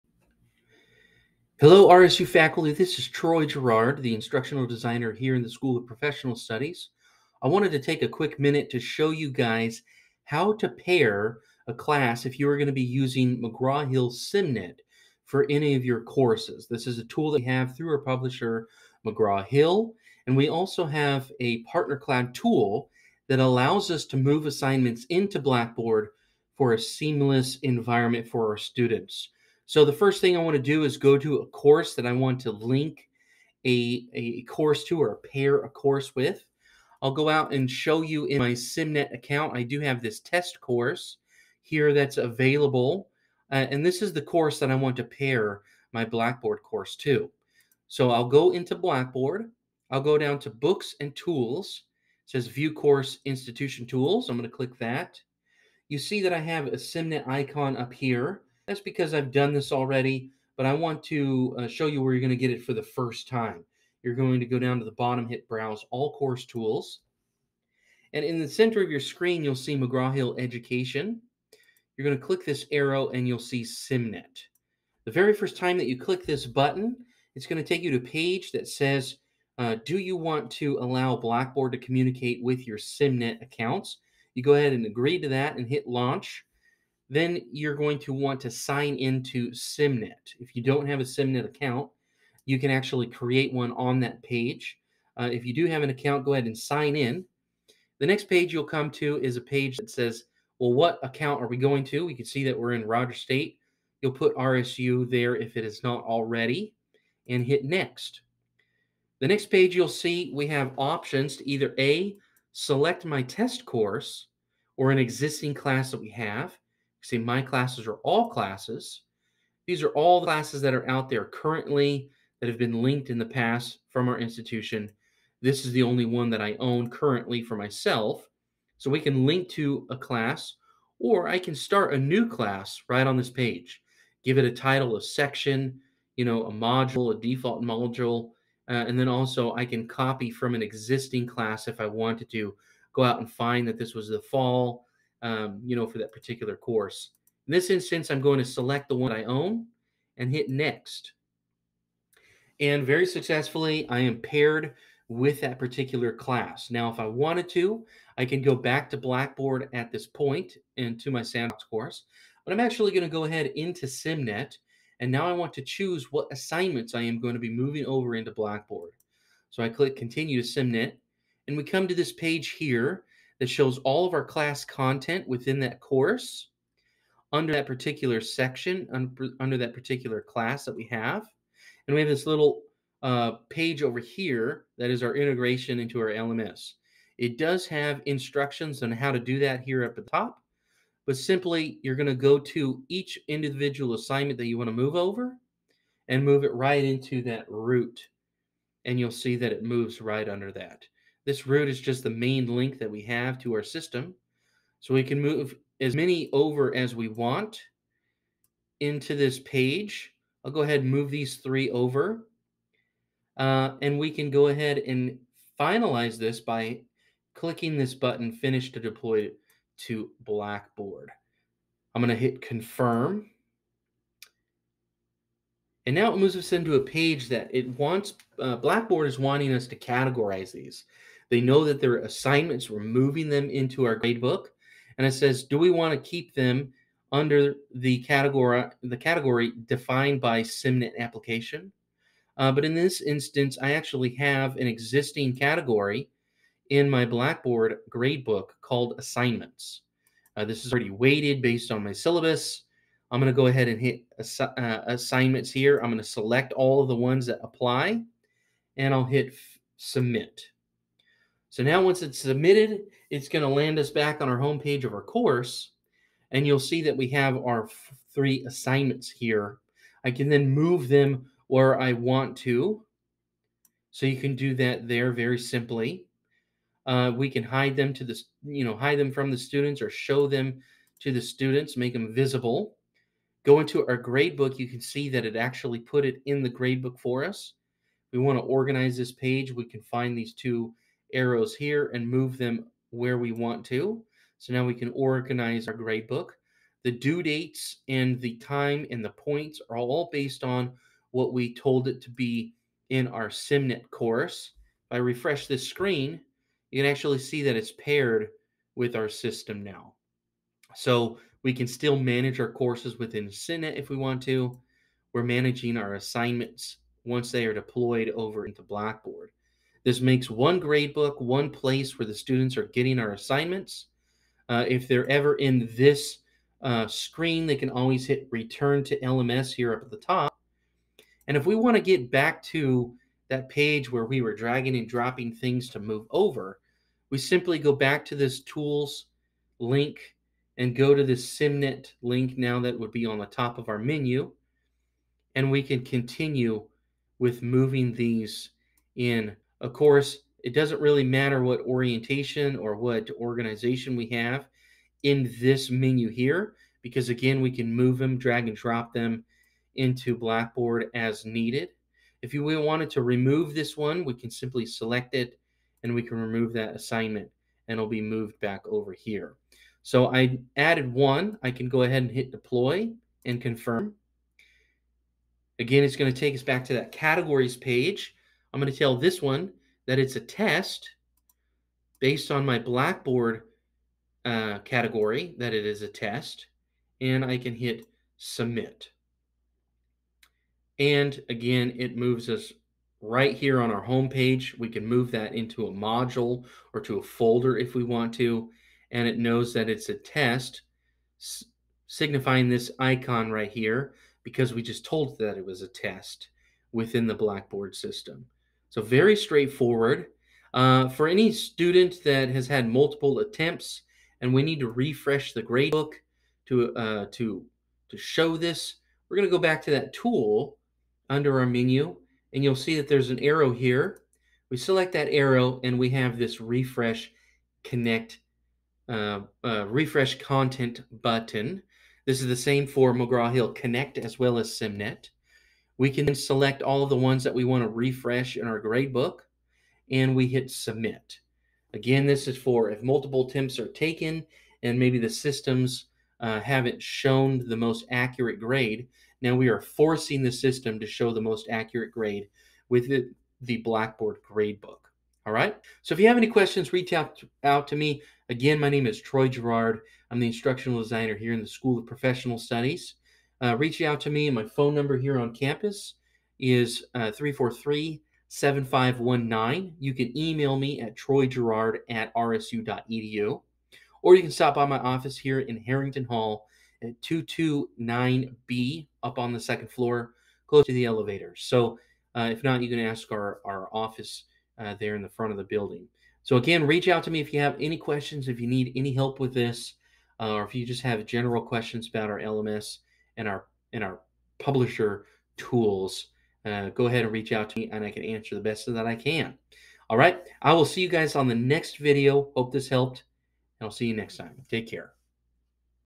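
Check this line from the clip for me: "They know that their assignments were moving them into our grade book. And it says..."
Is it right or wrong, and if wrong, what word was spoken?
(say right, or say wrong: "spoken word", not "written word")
right.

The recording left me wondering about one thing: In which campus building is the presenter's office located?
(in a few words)
Harrington Hall.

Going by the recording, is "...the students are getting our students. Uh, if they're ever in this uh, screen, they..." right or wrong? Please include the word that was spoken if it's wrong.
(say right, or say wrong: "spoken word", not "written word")
wrong: "assignments", not "students".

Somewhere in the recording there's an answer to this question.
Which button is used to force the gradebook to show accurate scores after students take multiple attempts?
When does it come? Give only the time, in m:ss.
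7:09.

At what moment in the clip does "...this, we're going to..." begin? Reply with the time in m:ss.
6:58.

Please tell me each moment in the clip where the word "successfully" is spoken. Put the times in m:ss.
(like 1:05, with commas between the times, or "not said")
2:33.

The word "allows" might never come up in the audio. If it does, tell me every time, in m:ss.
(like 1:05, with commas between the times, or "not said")
0:23, 1:20.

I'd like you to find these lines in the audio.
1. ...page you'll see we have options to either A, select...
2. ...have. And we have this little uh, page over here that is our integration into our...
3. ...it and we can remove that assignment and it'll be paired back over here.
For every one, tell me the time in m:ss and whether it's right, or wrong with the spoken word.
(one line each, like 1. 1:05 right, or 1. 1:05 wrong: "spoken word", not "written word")
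1. 1:49 right
2. 3:00 right
3. 6:05 wrong: "moved", not "paired".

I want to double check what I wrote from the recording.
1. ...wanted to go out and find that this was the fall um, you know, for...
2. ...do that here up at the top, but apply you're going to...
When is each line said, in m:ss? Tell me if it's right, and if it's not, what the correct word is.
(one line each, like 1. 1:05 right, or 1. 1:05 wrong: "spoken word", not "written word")
1. 2:21 right
2. 3:09 wrong: "simply", not "apply".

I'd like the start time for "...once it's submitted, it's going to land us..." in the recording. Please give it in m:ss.
4:21.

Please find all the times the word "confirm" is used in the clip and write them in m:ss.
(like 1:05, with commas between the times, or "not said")
3:42, 6:13.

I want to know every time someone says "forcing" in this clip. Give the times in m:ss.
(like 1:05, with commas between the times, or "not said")
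7:29.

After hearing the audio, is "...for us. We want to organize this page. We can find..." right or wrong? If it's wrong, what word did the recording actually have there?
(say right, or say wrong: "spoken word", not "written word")
right.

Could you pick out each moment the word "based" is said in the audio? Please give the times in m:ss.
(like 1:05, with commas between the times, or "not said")
4:11, 5:00, 6:21.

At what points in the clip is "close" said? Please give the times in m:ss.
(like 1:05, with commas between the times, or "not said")
8:00.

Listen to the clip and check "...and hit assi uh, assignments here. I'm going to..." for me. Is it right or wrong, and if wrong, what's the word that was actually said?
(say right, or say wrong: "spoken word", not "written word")
right.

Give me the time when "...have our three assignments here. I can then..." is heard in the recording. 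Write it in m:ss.
4:27.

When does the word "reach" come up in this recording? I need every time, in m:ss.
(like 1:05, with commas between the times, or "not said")
7:36, 7:43, 8:06, 8:17.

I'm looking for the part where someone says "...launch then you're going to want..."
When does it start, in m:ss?
1:25.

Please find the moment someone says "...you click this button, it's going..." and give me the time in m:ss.
1:15.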